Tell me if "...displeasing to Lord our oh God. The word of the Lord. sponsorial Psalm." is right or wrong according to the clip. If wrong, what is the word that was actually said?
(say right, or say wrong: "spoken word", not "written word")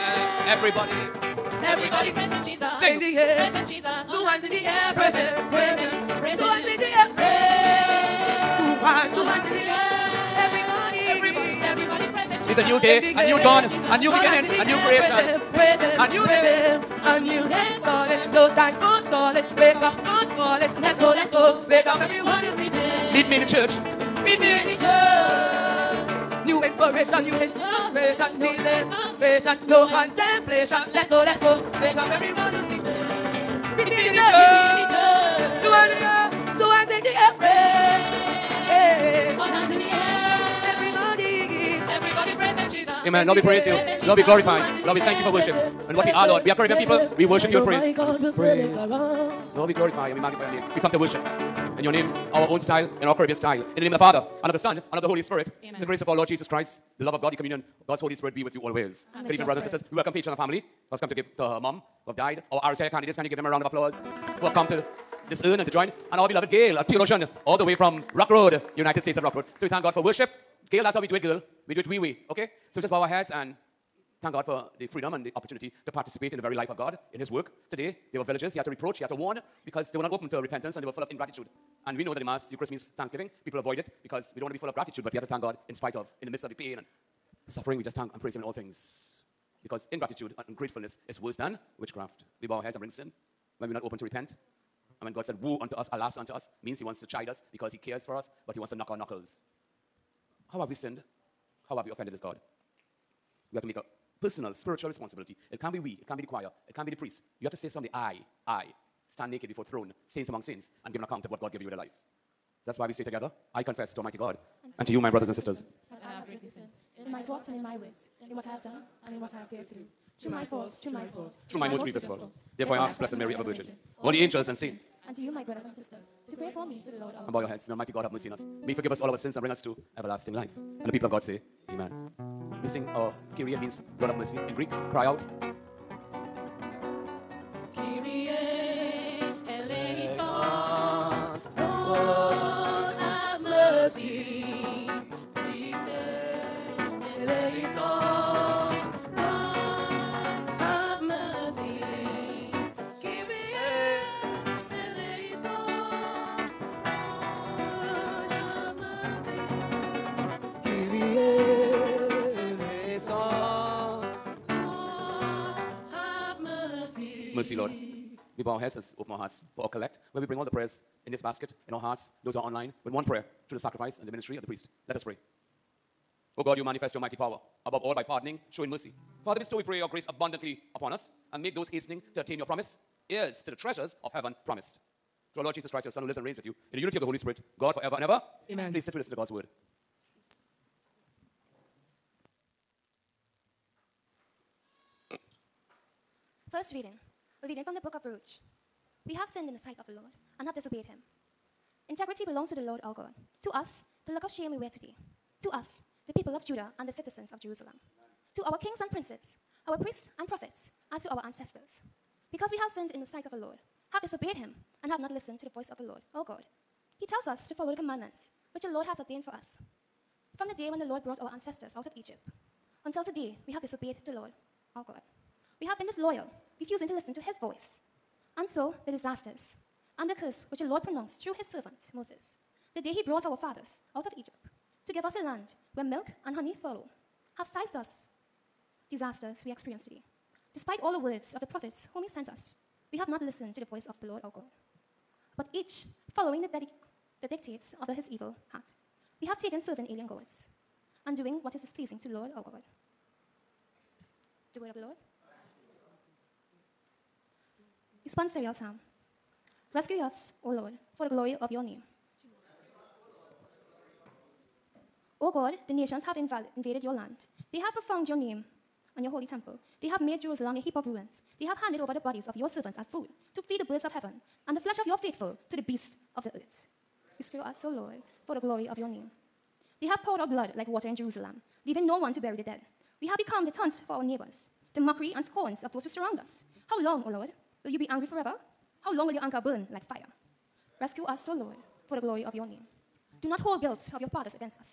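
right.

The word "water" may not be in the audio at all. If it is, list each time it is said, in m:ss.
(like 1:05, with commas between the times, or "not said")
4:40.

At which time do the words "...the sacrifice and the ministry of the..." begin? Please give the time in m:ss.
2:53.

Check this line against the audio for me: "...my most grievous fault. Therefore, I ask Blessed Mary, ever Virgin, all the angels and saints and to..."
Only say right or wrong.
right.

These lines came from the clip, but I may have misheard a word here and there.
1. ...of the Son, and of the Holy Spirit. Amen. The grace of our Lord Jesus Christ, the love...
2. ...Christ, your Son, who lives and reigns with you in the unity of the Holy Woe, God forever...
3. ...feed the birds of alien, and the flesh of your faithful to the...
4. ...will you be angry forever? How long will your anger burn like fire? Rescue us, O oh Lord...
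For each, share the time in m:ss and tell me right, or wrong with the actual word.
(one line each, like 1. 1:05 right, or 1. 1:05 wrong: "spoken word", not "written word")
1. 0:54 right
2. 3:05 wrong: "Spirit", not "Woe"
3. 4:33 wrong: "heaven", not "alien"
4. 4:47 right.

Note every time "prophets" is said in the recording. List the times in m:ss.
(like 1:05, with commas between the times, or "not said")
3:30, 4:01.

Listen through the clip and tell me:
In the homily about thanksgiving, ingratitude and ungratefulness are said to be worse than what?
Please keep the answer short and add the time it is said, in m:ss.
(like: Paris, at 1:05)
witchcraft, at 1:31.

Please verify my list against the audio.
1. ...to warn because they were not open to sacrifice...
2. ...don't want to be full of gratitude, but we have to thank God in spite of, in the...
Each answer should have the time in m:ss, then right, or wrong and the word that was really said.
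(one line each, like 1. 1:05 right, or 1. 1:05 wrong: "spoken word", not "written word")
1. 1:19 wrong: "repentance", not "sacrifice"
2. 1:24 right.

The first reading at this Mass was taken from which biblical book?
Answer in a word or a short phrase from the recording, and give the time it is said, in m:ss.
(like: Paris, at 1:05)
Baruch, at 3:18.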